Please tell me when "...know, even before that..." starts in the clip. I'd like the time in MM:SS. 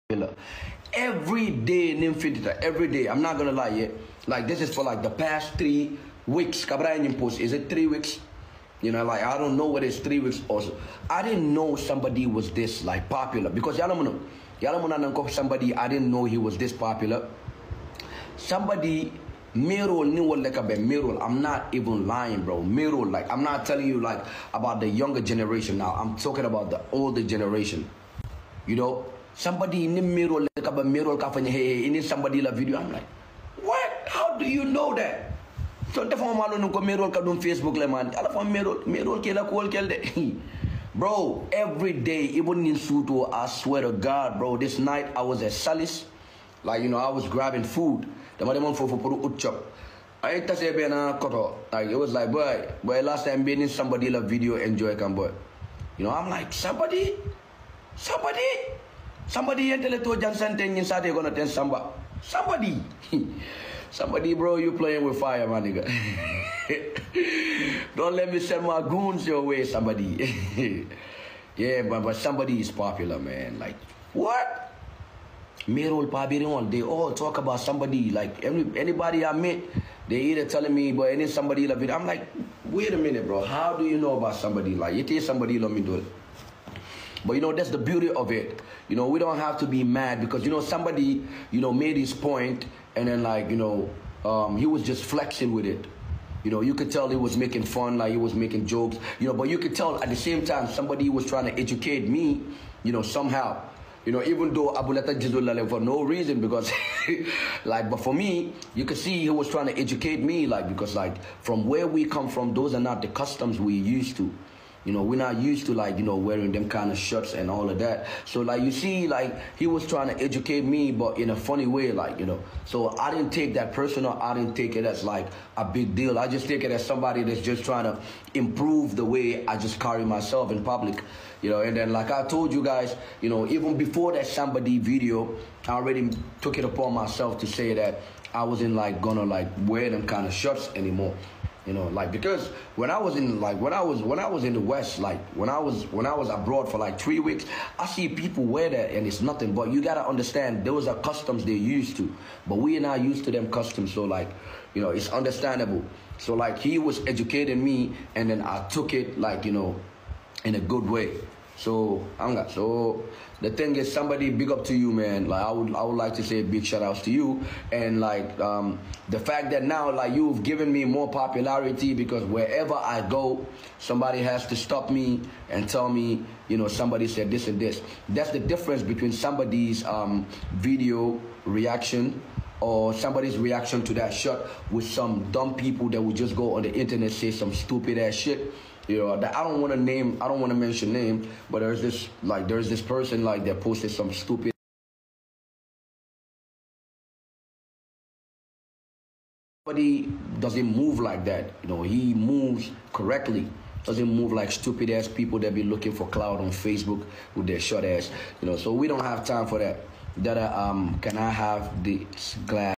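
02:13.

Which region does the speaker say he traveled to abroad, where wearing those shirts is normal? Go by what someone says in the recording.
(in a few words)
the West.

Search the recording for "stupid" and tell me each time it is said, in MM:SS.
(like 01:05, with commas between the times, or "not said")
03:07, 03:14, 03:24.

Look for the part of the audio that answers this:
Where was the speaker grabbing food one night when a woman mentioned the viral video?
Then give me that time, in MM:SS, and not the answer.
00:45.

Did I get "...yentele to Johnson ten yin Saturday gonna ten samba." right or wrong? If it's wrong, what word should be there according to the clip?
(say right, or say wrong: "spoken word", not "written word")
right.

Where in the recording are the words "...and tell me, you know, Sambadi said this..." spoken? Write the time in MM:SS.
02:55.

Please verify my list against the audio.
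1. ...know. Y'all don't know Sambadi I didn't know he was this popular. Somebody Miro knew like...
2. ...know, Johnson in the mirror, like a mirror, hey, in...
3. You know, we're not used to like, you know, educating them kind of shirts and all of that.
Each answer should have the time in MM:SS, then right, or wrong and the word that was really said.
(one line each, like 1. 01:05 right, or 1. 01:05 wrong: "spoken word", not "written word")
1. 00:14 right
2. 00:28 wrong: "Somebody", not "Johnson"
3. 01:54 wrong: "wearing", not "educating".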